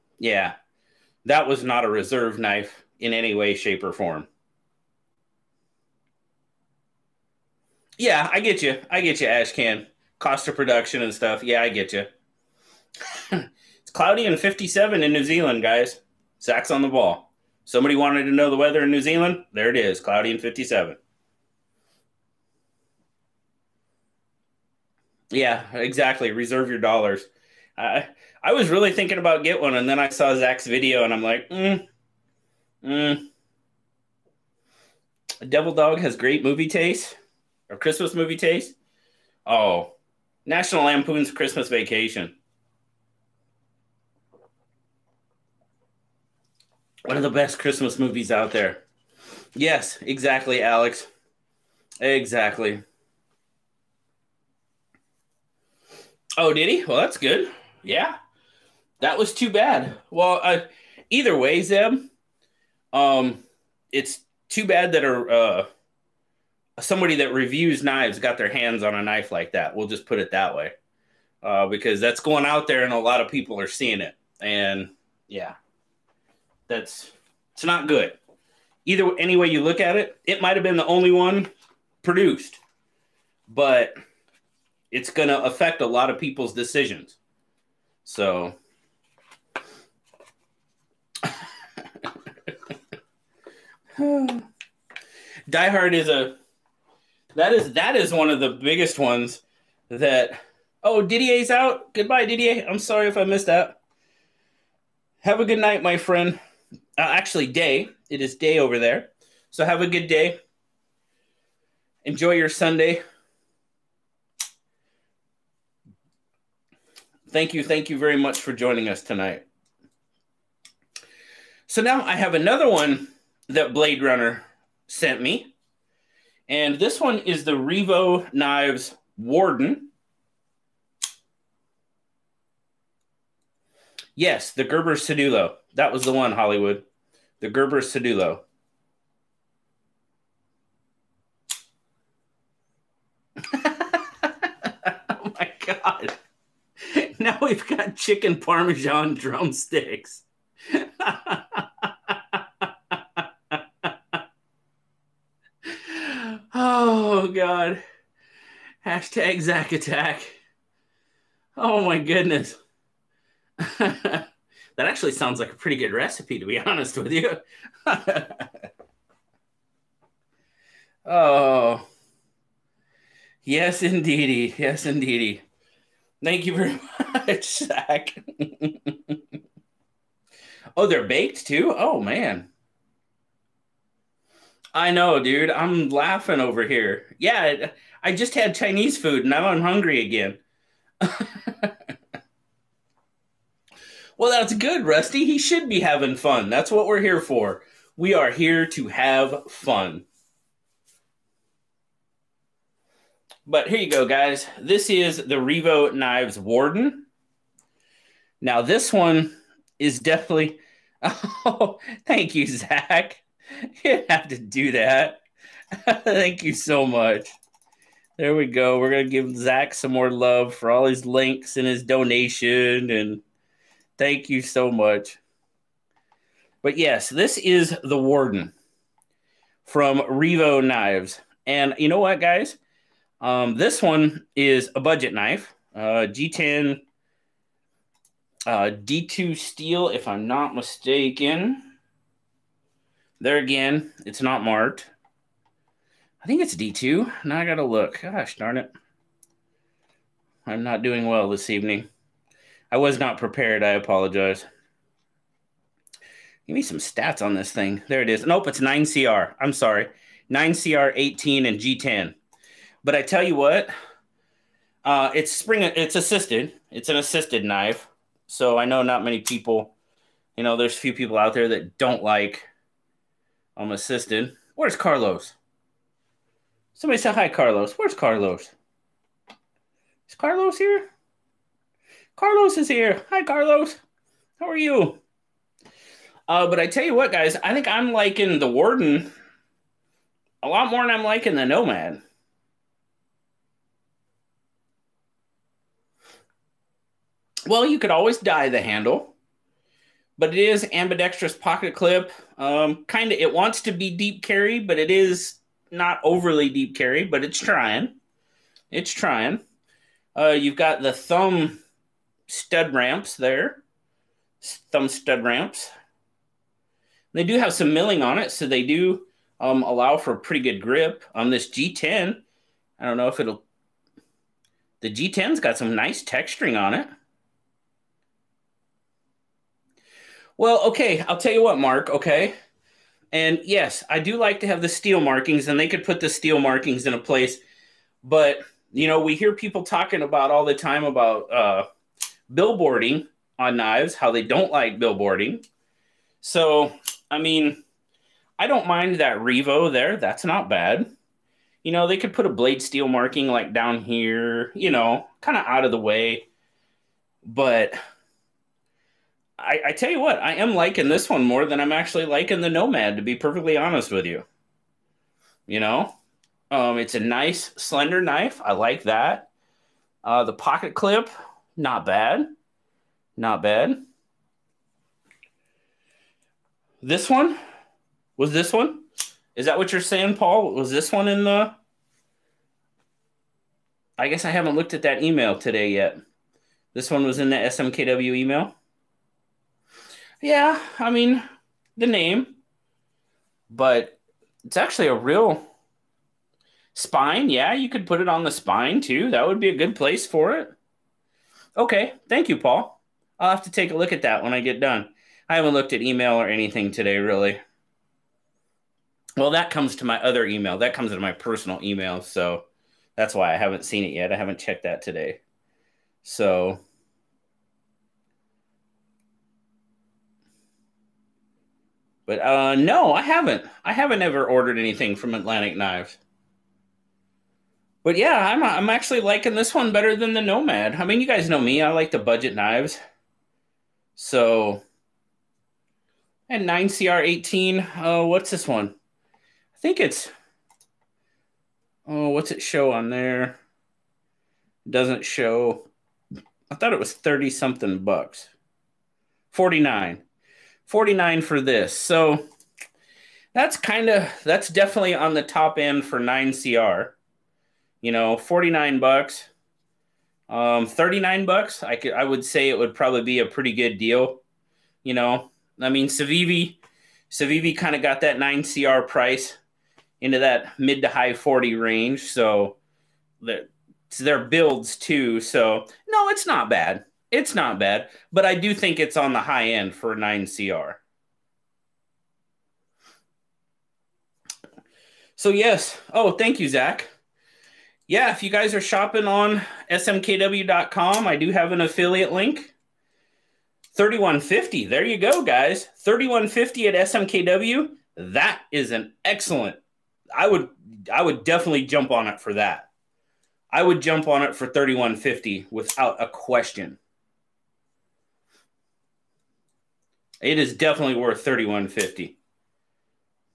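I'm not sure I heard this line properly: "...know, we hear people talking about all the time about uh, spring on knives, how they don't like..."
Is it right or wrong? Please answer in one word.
wrong.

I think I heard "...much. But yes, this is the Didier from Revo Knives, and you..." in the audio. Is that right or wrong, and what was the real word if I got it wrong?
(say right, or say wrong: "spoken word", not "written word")
wrong: "Warden", not "Didier".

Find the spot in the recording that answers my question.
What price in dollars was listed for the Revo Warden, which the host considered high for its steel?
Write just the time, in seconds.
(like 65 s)
449 s.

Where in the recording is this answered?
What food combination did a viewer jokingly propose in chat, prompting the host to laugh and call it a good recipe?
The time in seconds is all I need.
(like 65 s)
147 s.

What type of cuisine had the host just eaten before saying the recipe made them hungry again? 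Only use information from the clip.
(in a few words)
Chinese food.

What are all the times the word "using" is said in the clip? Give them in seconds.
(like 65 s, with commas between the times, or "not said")
not said.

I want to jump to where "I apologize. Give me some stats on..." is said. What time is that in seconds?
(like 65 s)
253 s.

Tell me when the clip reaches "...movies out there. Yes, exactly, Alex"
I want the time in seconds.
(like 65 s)
47 s.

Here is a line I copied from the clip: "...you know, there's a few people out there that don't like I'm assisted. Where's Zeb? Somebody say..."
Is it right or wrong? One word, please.
wrong.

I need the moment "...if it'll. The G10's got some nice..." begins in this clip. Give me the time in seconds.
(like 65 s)
323 s.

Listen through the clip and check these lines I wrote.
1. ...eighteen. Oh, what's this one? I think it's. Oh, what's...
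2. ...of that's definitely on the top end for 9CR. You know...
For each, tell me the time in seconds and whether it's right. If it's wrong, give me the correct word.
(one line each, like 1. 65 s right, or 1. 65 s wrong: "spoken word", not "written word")
1. 436 s right
2. 453 s right.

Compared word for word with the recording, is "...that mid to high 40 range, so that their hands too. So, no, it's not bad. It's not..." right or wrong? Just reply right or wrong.
wrong.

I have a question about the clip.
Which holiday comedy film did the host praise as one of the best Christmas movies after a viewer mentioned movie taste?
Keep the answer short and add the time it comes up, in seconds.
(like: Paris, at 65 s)
National Lampoon's Christmas Vacation, at 40 s.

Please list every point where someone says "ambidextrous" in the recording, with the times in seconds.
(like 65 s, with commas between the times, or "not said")
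300 s.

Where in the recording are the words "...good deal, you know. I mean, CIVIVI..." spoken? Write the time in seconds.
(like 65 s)
463 s.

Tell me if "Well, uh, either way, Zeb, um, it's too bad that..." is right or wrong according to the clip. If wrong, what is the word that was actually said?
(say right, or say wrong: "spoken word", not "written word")
right.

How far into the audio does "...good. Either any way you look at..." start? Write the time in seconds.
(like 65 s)
77 s.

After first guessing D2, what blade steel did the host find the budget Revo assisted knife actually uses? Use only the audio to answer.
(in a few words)
9CR18.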